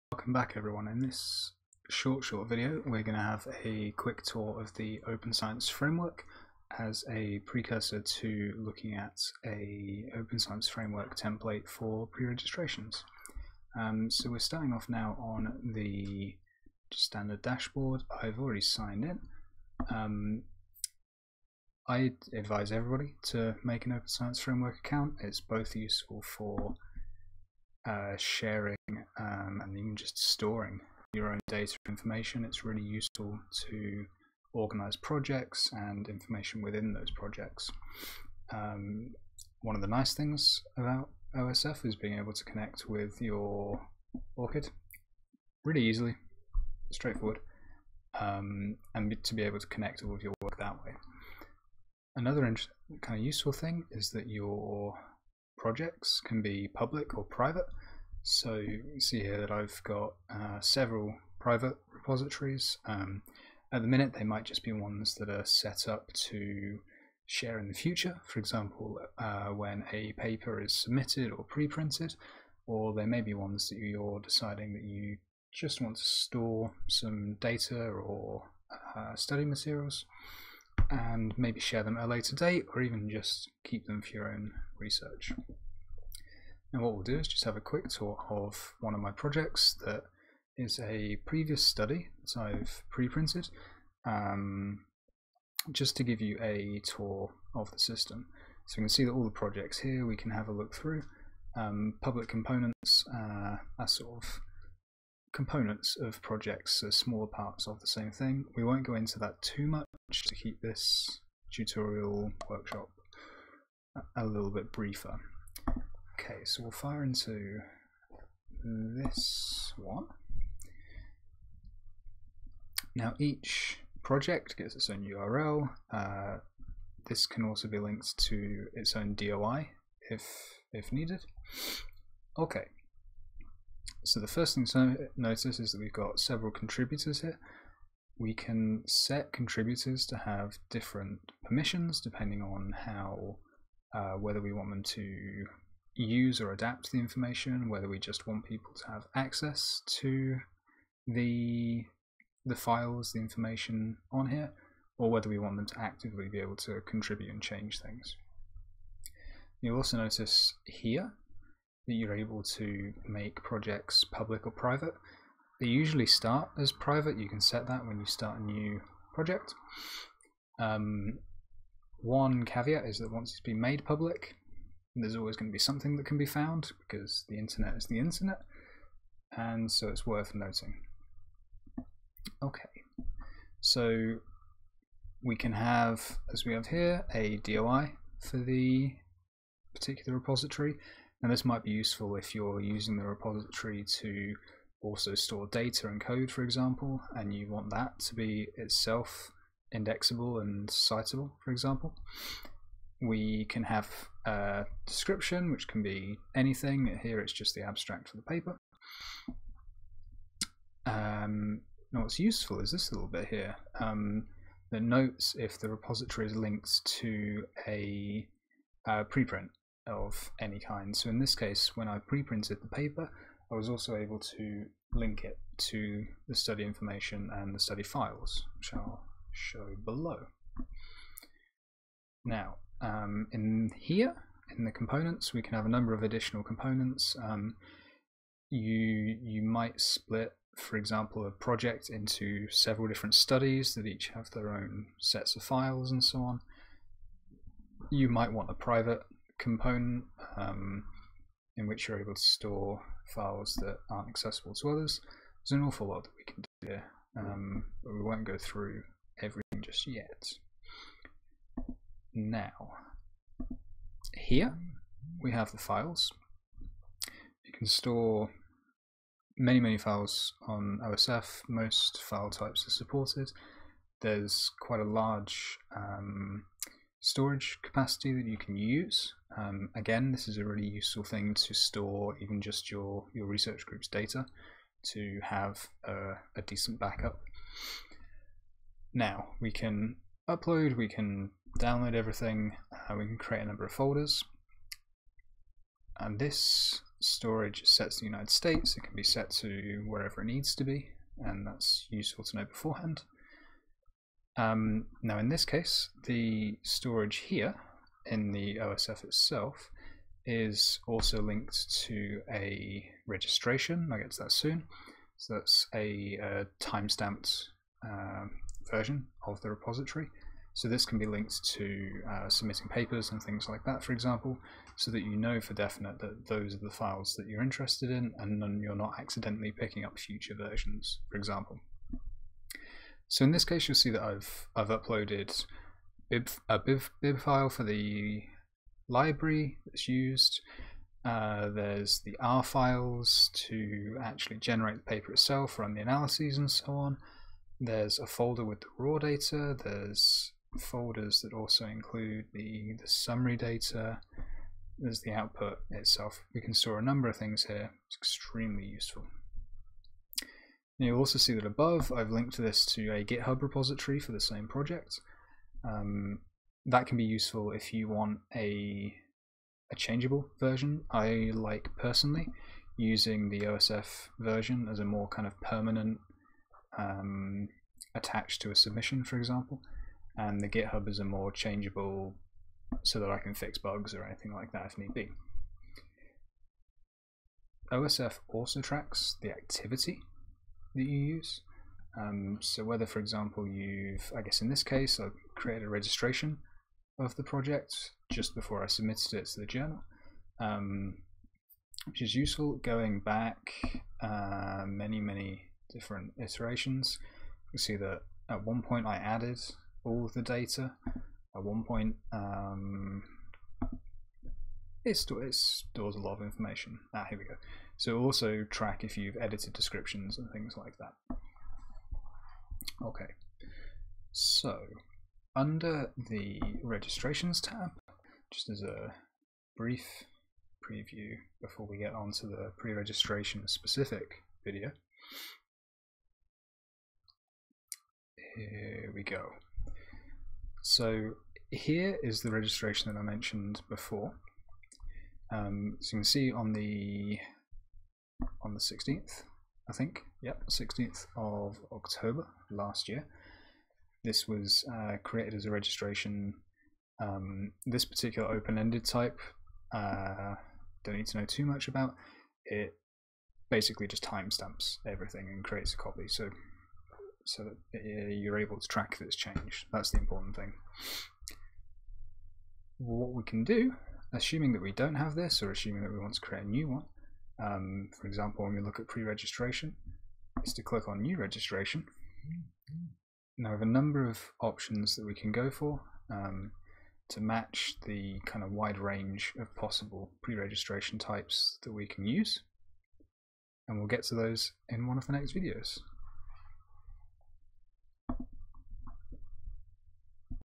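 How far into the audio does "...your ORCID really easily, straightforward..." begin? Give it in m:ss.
0:43.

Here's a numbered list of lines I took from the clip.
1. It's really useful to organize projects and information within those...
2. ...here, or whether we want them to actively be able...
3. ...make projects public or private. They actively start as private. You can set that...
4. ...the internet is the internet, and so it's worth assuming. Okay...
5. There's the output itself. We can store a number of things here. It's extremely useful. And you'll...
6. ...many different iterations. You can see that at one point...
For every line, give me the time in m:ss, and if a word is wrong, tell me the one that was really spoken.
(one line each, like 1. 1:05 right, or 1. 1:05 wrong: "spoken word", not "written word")
1. 0:32 right
2. 2:34 right
3. 2:43 wrong: "usually", not "actively"
4. 2:57 wrong: "noting", not "assuming"
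5. 5:54 right
6. 6:45 right.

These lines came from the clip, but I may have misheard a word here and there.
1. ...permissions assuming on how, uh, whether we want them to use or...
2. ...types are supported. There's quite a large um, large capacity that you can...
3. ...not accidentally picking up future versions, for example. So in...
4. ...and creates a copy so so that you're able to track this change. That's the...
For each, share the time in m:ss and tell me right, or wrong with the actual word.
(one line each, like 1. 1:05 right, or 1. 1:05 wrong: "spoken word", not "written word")
1. 2:21 wrong: "depending", not "assuming"
2. 4:32 wrong: "storage", not "large"
3. 5:28 right
4. 7:45 right.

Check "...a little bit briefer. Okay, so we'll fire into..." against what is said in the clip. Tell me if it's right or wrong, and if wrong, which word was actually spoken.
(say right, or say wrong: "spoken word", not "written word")
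right.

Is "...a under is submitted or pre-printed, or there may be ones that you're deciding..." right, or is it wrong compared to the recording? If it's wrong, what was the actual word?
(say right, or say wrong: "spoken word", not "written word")
wrong: "paper", not "under".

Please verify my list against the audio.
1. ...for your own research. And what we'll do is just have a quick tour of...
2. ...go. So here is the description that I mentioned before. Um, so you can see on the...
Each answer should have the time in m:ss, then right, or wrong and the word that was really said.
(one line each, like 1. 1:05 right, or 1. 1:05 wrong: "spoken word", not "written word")
1. 1:24 right
2. 7:19 wrong: "registration", not "description".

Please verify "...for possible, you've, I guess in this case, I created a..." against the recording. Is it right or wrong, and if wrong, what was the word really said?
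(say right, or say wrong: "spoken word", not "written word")
wrong: "example", not "possible".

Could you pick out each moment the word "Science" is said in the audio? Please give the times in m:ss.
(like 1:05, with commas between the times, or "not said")
0:05, 0:10, 0:24.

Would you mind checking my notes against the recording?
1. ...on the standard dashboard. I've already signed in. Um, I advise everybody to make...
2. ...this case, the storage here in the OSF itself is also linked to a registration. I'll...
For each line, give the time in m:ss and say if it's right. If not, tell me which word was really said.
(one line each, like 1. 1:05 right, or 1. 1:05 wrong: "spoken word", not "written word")
1. 0:15 right
2. 5:05 right.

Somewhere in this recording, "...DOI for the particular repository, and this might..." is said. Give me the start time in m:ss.
3:07.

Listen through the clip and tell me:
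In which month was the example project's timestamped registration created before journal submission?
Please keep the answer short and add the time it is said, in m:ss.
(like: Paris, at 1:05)
October, at 7:31.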